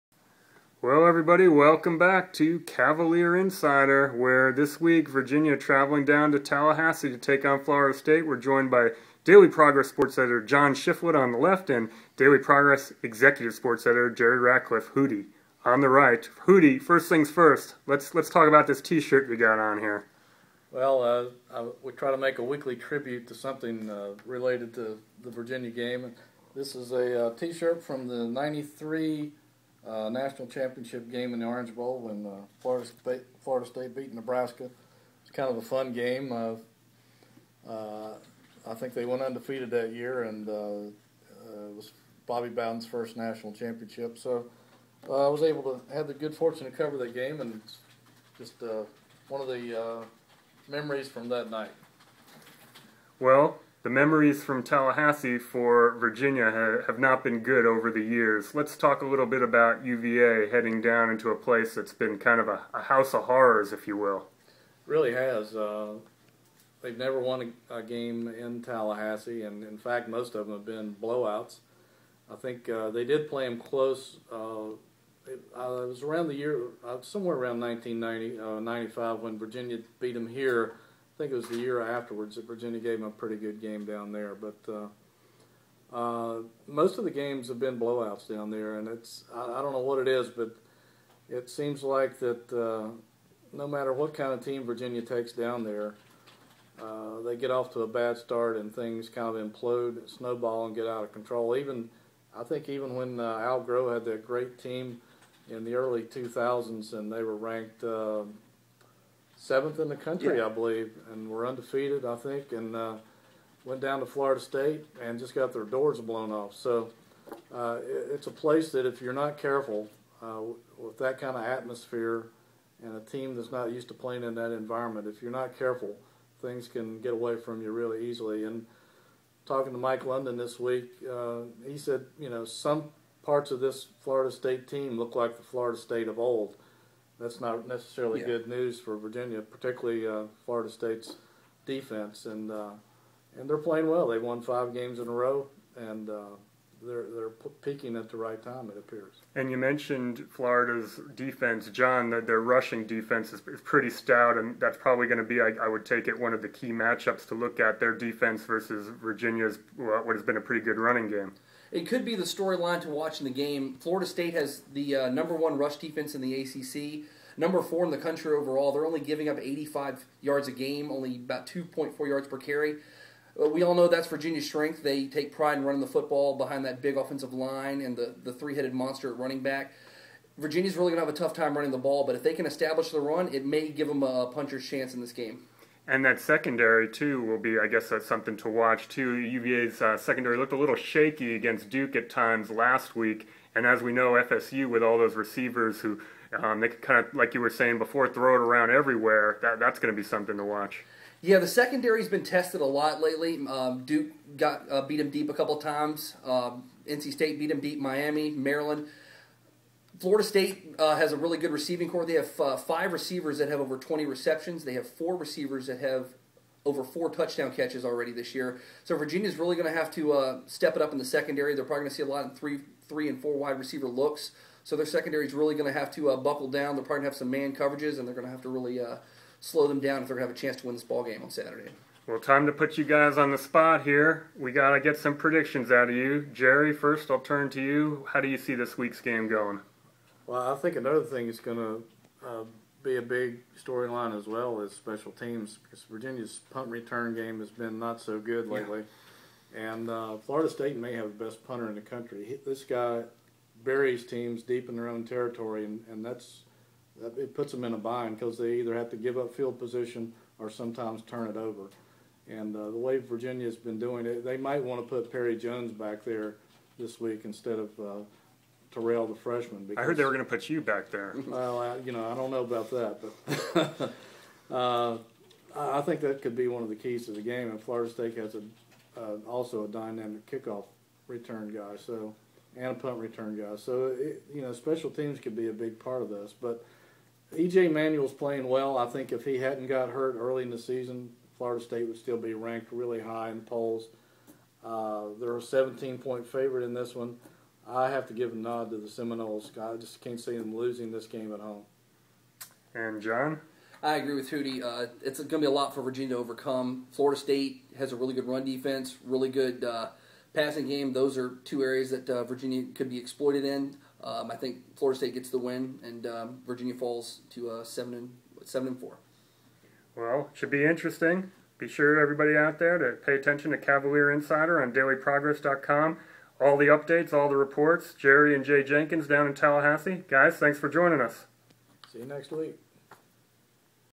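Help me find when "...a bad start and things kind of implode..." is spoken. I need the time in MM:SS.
01:37.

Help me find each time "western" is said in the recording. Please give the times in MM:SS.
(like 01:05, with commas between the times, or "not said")
not said.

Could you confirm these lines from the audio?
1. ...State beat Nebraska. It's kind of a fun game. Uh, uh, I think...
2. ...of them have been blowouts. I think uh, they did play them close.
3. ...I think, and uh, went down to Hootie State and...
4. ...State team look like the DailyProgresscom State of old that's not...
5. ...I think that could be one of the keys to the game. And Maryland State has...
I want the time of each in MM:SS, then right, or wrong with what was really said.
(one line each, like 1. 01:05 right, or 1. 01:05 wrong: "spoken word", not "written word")
1. 00:33 right
2. 01:10 right
3. 01:52 wrong: "Florida", not "Hootie"
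4. 02:14 wrong: "Florida", not "DailyProgresscom"
5. 04:35 wrong: "Florida", not "Maryland".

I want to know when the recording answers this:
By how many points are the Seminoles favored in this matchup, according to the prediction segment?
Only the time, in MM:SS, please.
04:55.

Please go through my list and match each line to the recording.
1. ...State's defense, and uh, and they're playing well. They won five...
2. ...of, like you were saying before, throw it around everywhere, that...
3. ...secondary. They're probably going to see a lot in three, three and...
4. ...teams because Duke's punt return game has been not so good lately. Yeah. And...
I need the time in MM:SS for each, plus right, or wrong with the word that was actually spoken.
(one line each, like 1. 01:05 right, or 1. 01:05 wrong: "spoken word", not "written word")
1. 02:20 right
2. 03:17 right
3. 03:41 right
4. 04:05 wrong: "Virginia", not "Duke".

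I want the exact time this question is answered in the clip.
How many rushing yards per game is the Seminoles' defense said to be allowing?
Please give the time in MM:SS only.
02:49.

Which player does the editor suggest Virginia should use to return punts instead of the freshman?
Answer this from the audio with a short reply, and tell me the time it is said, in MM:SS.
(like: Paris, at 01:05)
Perry Jones, at 04:25.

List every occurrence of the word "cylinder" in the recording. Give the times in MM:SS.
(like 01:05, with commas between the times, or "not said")
not said.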